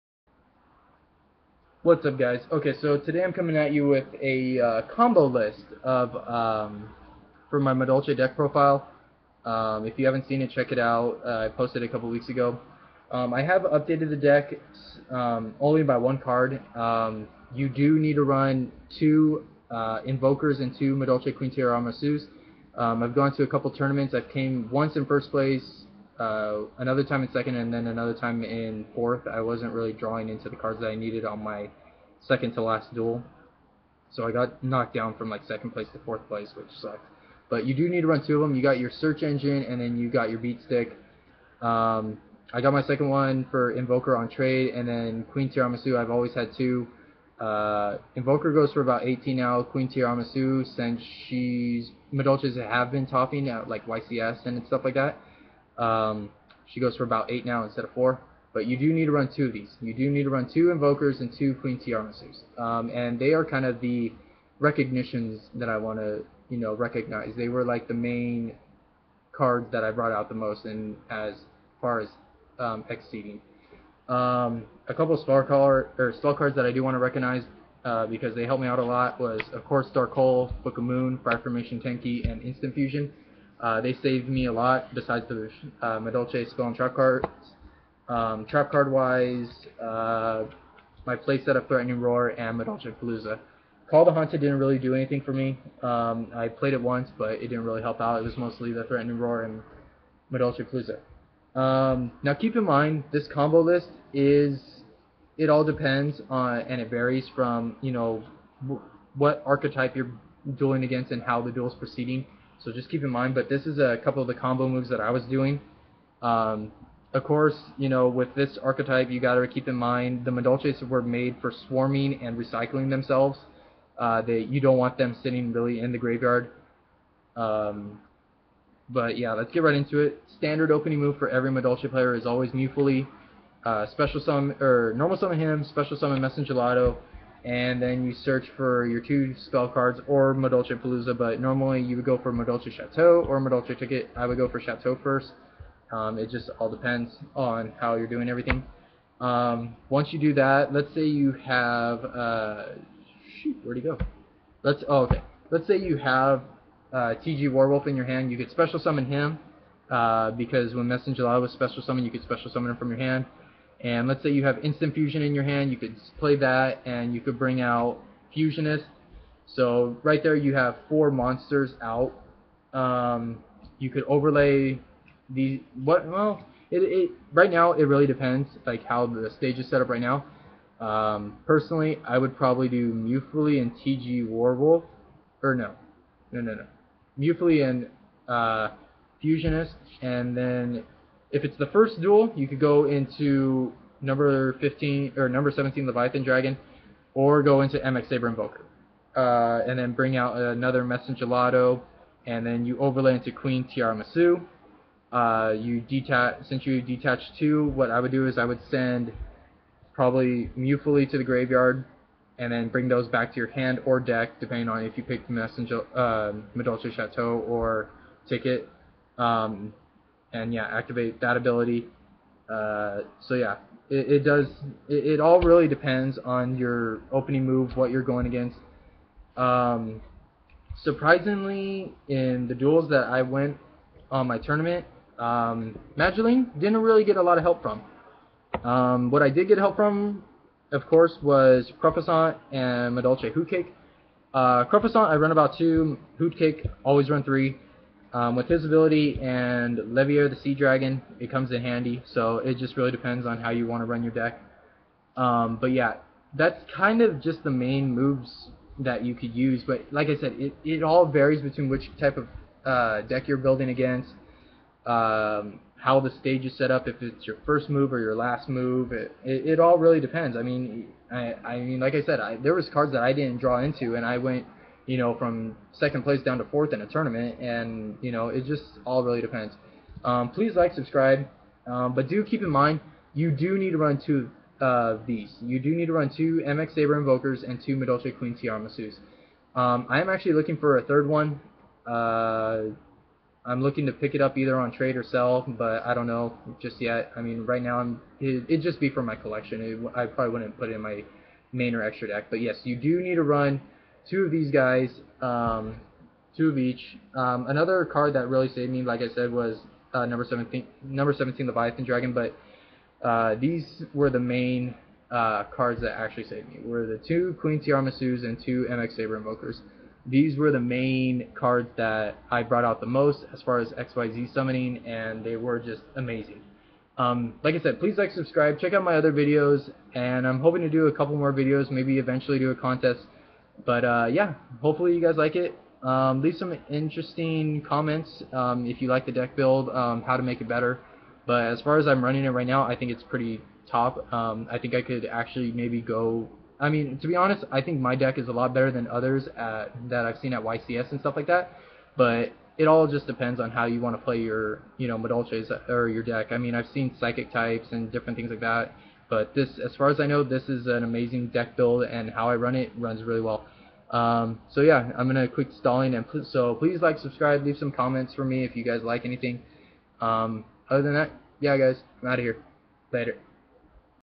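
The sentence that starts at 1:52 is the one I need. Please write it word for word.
So just keep in mind, but this is a couple of the combo moves that I was doing.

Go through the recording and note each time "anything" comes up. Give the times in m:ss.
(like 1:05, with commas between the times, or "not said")
1:34, 6:09.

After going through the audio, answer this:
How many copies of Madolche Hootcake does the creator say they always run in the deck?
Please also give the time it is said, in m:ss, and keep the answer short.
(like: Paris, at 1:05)
3, at 4:07.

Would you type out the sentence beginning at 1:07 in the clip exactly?
They were like the main cards that I brought out the most and as far as um, exceeding.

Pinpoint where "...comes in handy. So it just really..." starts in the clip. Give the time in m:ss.
4:11.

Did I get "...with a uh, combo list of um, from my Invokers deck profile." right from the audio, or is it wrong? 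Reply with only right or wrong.
wrong.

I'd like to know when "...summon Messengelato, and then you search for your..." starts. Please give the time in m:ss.
2:15.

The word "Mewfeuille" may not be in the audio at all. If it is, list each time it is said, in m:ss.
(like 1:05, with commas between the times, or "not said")
2:12, 3:02, 3:07, 3:30.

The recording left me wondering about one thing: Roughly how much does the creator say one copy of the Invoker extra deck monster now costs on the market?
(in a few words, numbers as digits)
18.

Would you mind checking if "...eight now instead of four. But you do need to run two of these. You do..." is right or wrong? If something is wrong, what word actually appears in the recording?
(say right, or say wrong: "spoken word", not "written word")
right.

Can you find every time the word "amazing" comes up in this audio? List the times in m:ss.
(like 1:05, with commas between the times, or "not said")
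5:25, 6:00.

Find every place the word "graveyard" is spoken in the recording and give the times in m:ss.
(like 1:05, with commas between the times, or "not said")
2:05, 3:31.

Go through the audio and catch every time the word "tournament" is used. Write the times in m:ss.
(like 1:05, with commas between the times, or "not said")
0:23, 3:54, 4:36.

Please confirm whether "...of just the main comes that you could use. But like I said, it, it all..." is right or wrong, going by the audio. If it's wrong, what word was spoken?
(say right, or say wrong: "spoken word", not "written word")
wrong: "moves", not "comes".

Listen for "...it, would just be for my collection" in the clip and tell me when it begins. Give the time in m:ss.
4:58.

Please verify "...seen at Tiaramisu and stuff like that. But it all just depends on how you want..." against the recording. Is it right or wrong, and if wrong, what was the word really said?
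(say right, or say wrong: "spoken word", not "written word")
wrong: "YCS", not "Tiaramisu".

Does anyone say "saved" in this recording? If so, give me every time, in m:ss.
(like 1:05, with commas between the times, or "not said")
1:24, 5:08, 5:16.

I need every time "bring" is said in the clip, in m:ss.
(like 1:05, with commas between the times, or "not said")
2:47, 3:19, 3:32.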